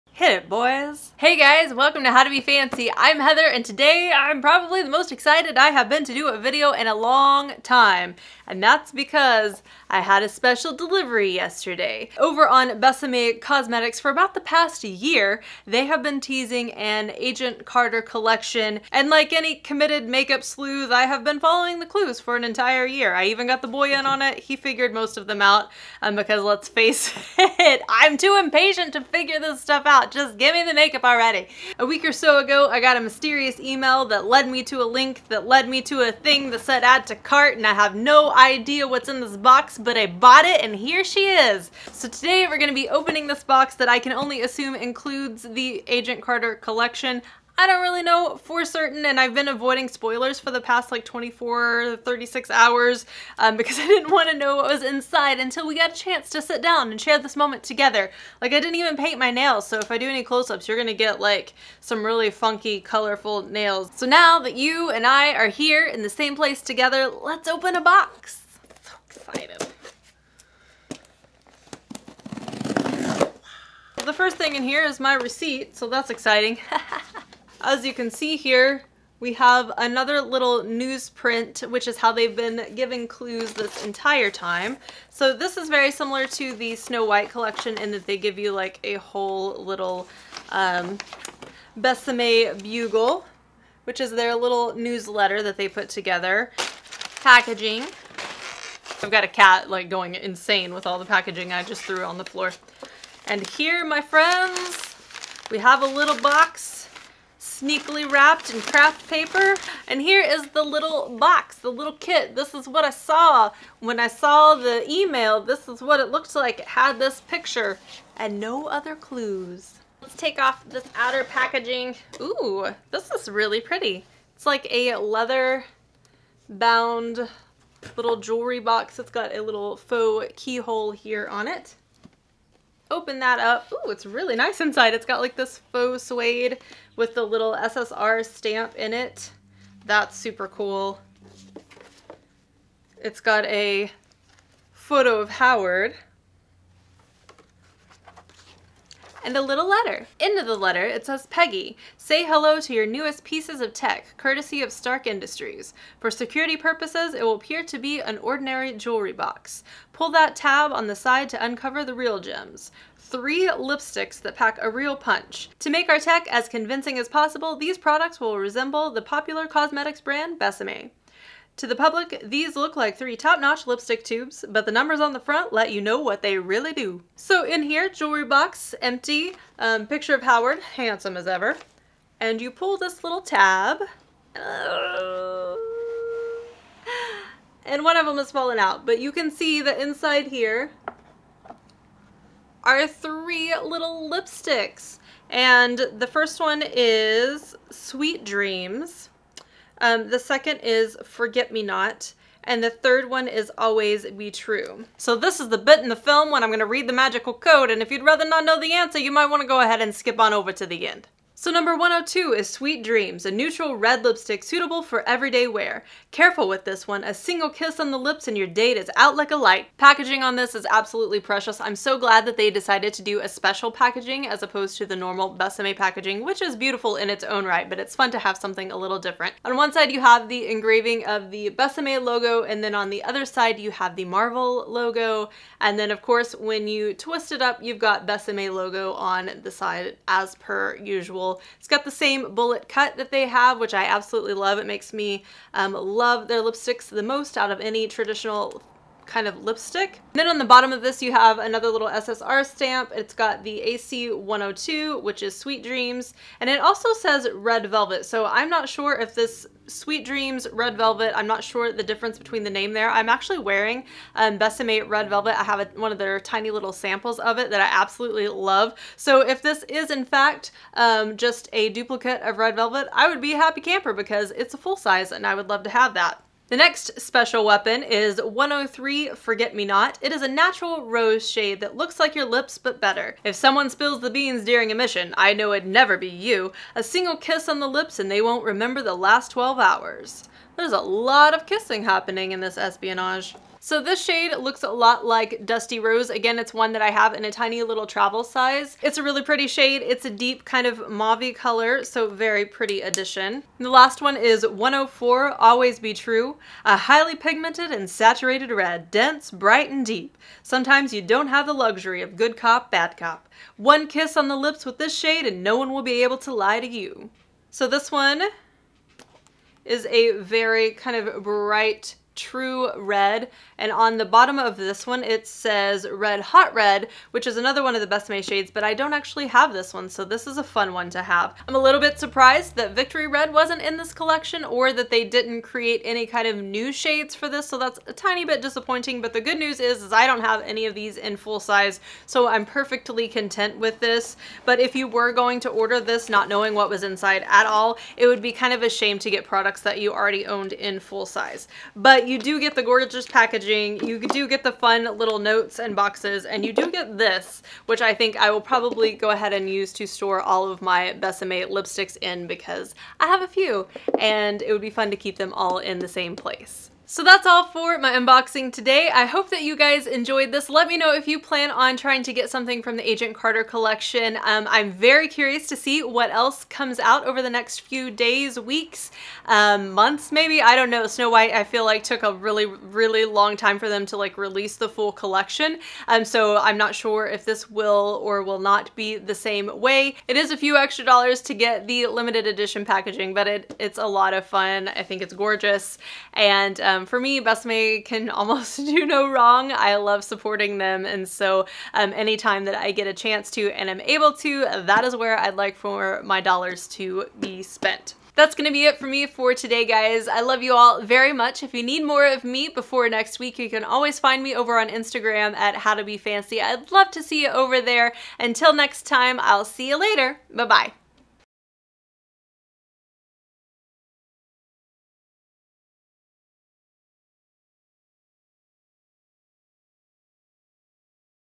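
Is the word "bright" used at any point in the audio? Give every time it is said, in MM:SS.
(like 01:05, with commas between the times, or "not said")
05:09, 05:21.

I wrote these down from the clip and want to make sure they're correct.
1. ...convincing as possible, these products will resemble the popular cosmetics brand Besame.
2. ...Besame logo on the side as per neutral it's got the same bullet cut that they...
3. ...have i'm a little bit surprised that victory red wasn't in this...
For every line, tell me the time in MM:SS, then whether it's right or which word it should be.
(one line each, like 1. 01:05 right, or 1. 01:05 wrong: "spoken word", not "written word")
1. 02:46 right
2. 03:58 wrong: "usual", not "neutral"
3. 05:31 right.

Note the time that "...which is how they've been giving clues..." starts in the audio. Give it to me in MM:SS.
01:21.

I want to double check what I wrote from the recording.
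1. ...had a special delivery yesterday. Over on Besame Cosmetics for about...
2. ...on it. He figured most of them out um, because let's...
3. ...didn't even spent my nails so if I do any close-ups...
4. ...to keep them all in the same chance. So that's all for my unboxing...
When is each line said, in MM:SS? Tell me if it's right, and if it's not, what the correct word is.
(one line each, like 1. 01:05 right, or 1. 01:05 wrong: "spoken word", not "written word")
1. 00:10 right
2. 00:24 right
3. 00:58 wrong: "paint", not "spent"
4. 06:04 wrong: "place", not "chance".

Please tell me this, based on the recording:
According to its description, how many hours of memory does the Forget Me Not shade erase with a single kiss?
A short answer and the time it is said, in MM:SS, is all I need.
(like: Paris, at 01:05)
12, at 04:49.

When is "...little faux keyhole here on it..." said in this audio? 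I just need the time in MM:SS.
02:09.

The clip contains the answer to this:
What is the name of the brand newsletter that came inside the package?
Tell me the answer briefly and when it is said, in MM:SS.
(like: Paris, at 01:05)
Besame Bugle, at 01:31.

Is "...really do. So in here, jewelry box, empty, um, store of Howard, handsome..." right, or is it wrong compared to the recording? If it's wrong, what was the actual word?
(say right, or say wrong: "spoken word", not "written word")
wrong: "picture", not "store".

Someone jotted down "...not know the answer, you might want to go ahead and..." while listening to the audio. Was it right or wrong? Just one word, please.
right.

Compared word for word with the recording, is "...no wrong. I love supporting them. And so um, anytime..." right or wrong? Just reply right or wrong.
right.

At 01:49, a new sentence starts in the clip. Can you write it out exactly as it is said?
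And here is the little box, the little kit.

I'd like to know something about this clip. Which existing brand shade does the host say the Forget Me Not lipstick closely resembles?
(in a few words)
Dusty Rose.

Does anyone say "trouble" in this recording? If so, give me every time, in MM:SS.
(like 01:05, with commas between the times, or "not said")
not said.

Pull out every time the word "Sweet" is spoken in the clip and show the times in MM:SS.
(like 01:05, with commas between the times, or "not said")
03:17, 03:32, 04:15, 04:19.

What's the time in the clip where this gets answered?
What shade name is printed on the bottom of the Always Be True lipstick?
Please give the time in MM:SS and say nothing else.
05:25.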